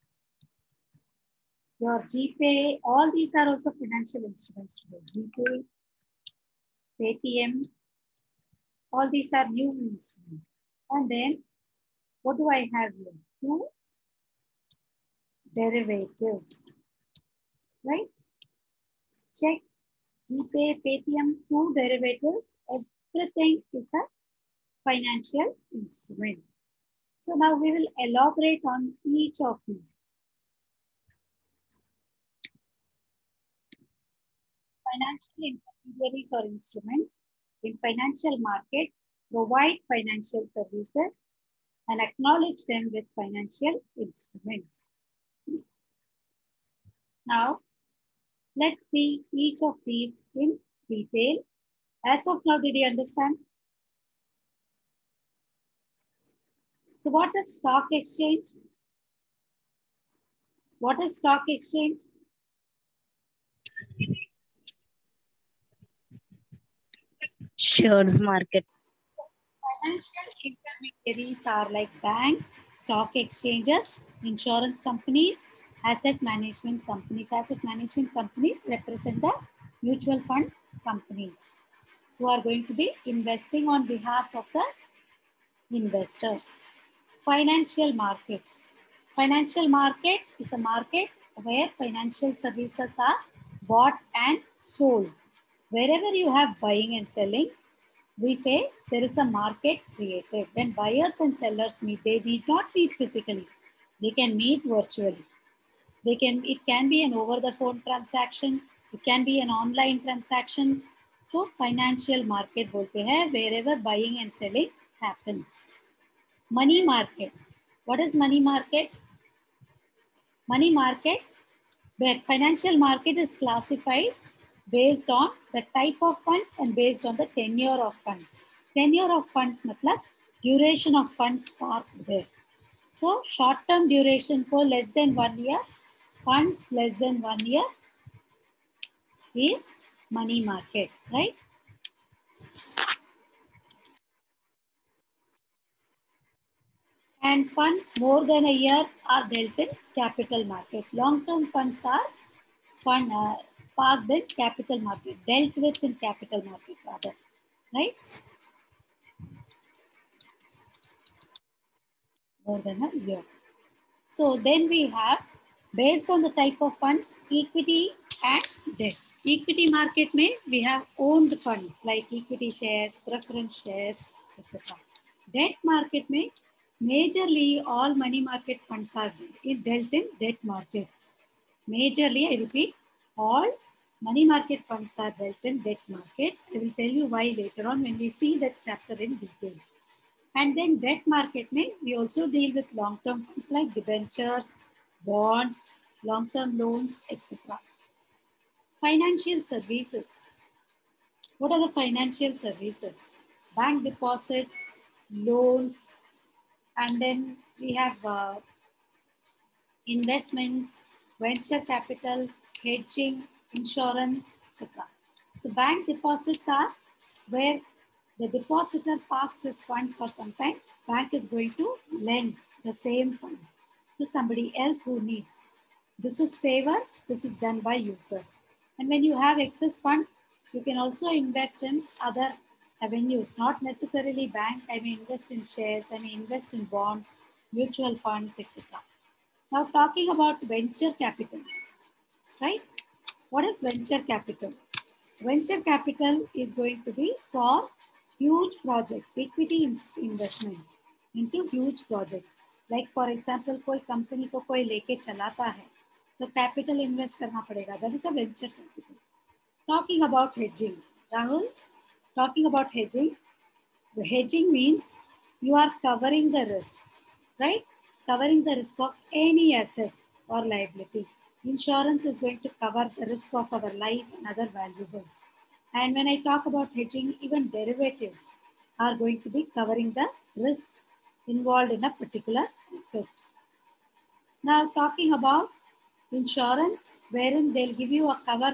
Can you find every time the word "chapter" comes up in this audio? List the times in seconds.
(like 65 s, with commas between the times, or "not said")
188 s.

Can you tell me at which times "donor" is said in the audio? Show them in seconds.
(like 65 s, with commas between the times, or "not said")
not said.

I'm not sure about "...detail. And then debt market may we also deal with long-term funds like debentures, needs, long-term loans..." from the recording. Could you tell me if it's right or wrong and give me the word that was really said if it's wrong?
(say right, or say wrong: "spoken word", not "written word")
wrong: "bonds", not "needs".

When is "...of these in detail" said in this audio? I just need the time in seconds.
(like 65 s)
49 s.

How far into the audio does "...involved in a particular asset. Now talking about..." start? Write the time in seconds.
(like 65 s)
281 s.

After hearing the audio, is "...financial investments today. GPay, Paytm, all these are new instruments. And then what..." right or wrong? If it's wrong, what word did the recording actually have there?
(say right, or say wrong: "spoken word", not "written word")
wrong: "instruments", not "investments".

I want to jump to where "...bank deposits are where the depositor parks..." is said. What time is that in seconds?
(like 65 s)
215 s.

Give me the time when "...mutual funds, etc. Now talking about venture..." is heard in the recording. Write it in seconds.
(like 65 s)
237 s.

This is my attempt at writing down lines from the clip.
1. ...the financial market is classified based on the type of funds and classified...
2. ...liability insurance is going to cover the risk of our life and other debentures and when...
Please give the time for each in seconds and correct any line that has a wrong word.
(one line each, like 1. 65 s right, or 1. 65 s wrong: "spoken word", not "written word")
1. 121 s wrong: "based", not "classified"
2. 270 s wrong: "valuables", not "debentures".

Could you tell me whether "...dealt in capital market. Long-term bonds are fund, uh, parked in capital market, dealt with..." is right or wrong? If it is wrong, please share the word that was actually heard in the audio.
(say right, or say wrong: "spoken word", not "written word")
wrong: "funds", not "bonds".